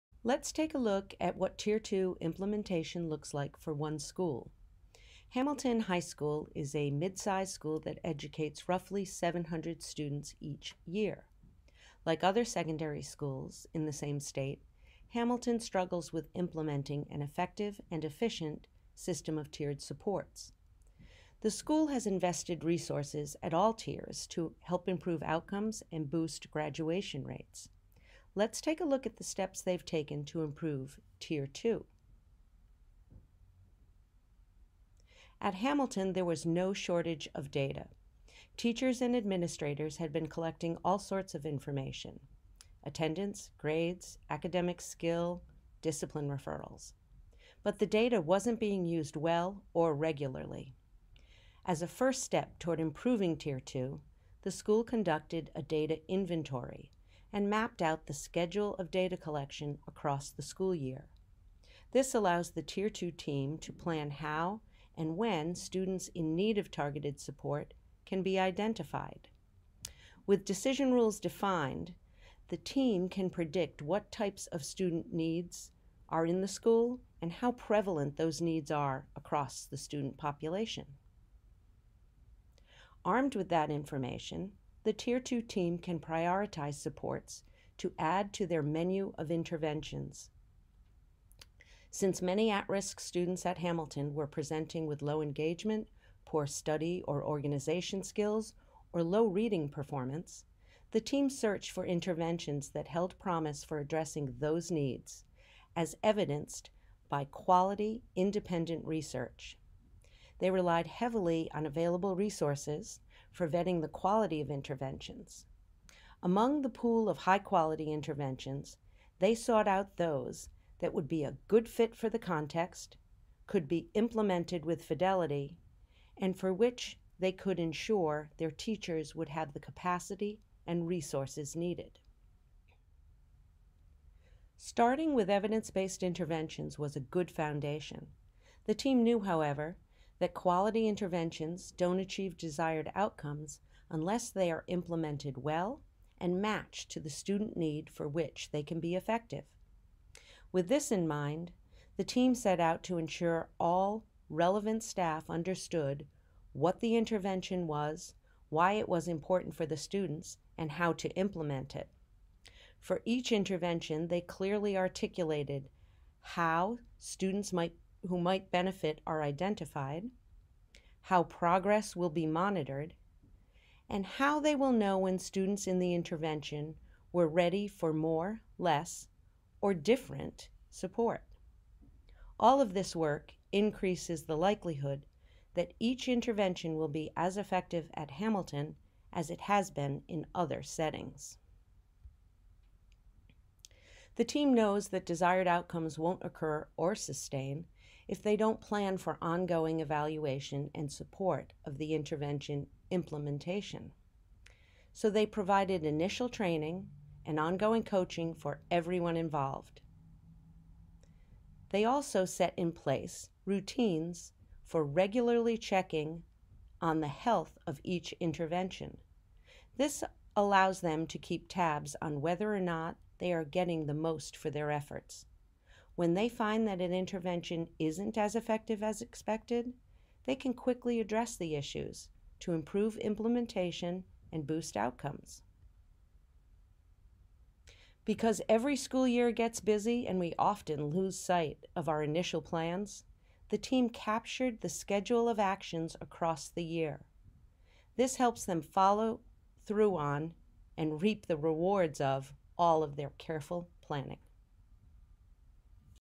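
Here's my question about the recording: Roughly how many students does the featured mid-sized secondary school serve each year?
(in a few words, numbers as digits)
700.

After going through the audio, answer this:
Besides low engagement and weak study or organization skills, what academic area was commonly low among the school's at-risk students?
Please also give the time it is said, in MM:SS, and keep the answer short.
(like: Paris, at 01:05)
reading performance, at 01:39.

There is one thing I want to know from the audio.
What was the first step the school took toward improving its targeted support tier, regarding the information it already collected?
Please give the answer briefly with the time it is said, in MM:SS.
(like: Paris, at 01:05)
data inventory, at 00:55.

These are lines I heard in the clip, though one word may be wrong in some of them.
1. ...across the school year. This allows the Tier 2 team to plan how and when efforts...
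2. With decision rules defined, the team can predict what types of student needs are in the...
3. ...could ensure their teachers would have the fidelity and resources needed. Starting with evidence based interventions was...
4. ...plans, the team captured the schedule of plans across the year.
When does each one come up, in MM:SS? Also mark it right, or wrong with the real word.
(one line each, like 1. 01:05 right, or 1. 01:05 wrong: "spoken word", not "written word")
1. 00:59 wrong: "students", not "efforts"
2. 01:10 right
3. 02:07 wrong: "capacity", not "fidelity"
4. 04:02 wrong: "actions", not "plans".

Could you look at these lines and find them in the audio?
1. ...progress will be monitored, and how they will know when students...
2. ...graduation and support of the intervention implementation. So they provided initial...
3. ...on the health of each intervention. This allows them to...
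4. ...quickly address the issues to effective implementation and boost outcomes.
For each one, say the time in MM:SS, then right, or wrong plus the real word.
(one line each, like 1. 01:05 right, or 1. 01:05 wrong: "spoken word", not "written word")
1. 02:51 right
2. 03:19 wrong: "evaluation", not "graduation"
3. 03:36 right
4. 03:50 wrong: "improve", not "effective".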